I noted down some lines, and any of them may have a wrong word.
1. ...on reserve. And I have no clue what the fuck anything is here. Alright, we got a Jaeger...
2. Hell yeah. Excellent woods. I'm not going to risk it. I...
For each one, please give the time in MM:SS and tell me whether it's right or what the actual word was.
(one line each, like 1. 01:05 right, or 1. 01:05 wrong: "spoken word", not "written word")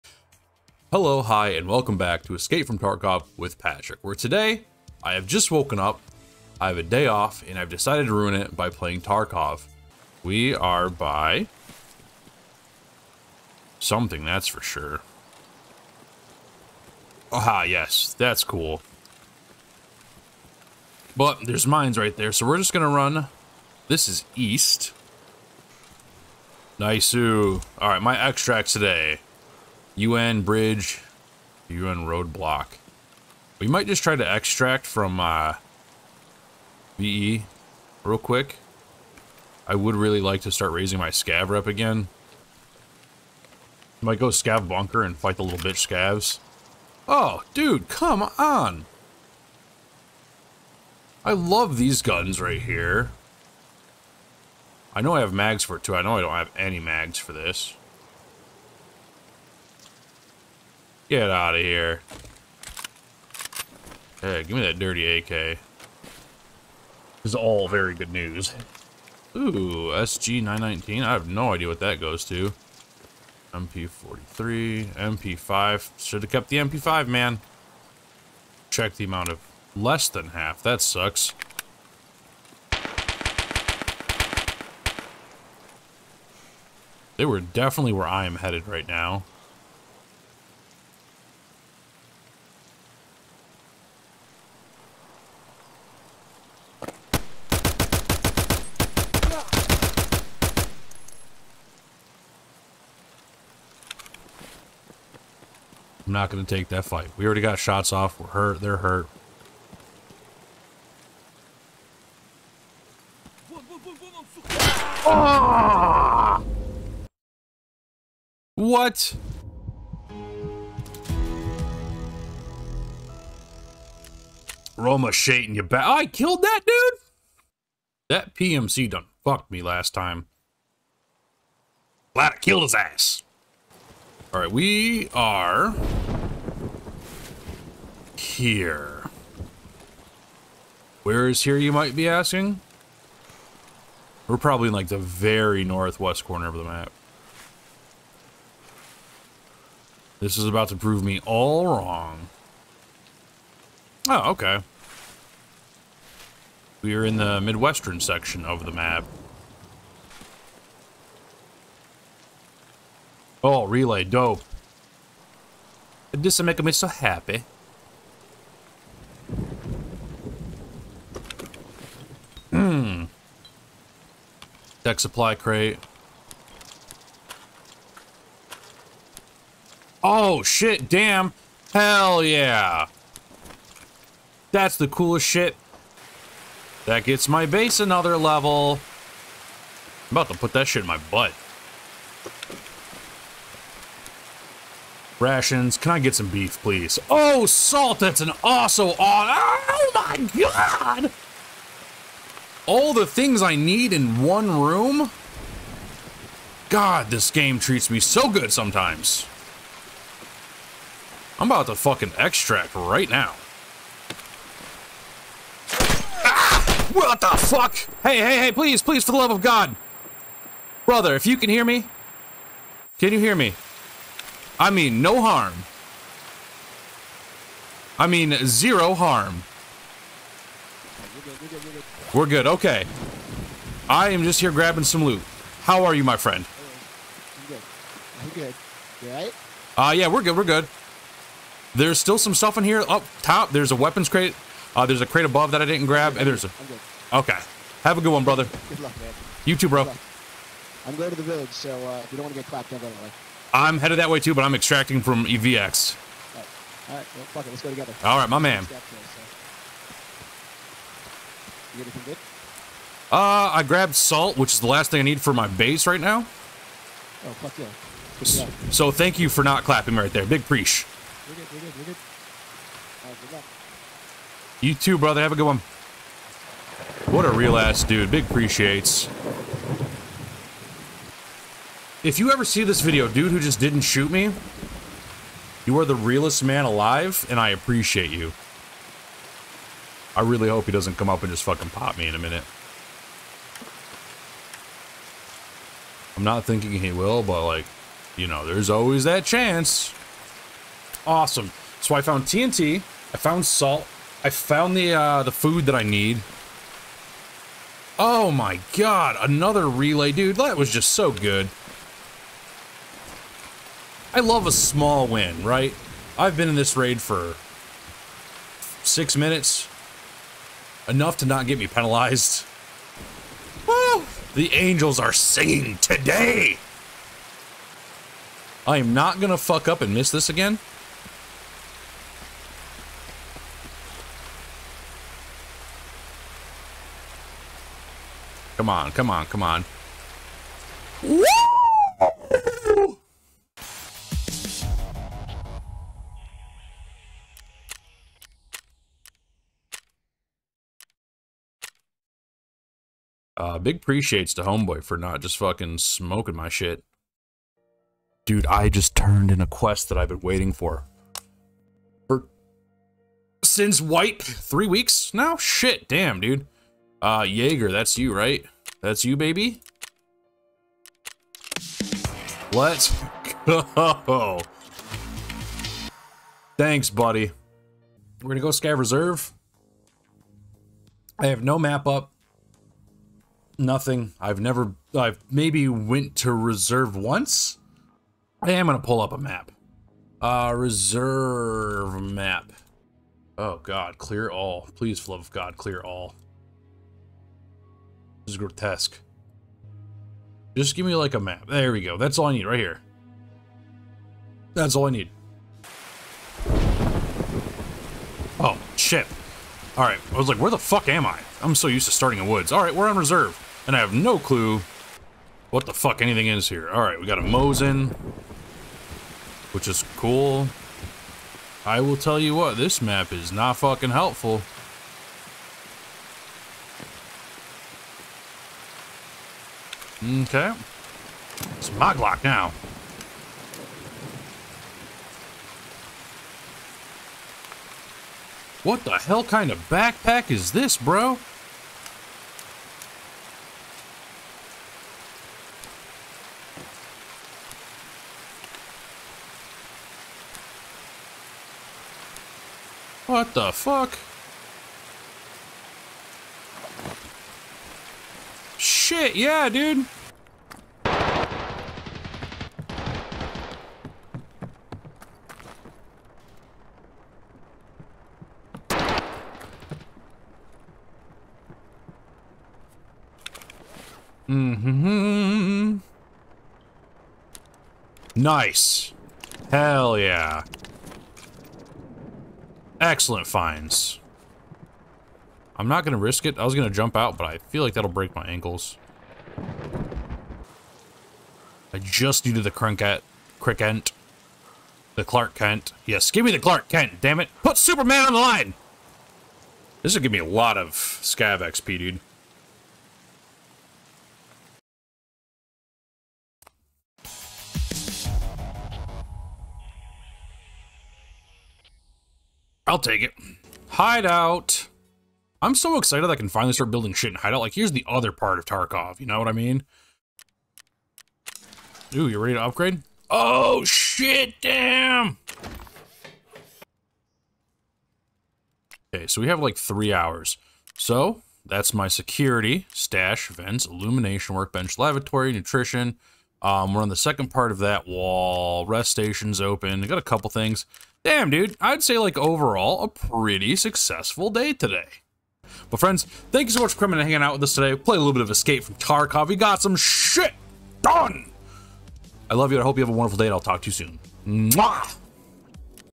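1. 06:52 wrong: "Mosin", not "Jaeger"
2. 07:59 wrong: "finds", not "woods".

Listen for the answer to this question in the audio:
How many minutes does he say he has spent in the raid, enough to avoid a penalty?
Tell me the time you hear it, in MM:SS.
05:18.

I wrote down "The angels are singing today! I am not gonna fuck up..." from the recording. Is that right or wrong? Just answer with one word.
right.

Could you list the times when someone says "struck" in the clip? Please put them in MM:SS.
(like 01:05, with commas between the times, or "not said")
not said.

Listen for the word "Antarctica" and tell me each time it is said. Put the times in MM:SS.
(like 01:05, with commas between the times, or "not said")
not said.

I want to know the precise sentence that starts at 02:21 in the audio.
Where is here, you might be asking?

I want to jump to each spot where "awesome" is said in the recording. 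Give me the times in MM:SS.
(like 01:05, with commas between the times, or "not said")
03:18, 05:01.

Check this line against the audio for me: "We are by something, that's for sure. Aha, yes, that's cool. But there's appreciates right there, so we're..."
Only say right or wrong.
wrong.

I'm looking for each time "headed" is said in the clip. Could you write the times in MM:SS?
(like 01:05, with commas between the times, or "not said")
01:28, 04:13.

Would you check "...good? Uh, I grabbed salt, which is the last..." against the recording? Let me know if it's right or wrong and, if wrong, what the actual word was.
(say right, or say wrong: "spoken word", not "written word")
right.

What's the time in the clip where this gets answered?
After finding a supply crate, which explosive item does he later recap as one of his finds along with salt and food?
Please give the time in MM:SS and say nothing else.
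05:02.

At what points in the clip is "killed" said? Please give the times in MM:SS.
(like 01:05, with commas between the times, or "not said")
02:06, 02:12.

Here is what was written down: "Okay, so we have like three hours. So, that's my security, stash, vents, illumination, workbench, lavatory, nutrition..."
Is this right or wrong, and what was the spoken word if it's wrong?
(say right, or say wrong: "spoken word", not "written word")
right.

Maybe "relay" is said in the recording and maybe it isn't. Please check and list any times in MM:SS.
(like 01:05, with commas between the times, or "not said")
02:43, 05:09.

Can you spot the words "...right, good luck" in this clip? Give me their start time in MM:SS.
04:33.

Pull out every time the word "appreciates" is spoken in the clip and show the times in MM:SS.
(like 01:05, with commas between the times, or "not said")
04:38, 04:47, 05:53.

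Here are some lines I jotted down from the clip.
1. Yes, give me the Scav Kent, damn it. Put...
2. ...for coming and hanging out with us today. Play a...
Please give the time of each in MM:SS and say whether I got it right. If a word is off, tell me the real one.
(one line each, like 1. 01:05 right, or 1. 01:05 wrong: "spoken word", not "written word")
1. 08:15 wrong: "Clark", not "Scav"
2. 09:06 right.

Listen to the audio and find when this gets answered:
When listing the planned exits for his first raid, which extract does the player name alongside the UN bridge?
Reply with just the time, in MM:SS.
00:31.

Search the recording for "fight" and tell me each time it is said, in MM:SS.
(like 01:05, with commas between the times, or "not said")
00:45, 01:46.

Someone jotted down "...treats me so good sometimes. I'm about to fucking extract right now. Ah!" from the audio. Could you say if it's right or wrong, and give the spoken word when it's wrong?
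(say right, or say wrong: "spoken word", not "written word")
right.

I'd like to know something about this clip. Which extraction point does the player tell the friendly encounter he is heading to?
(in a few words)
EVX.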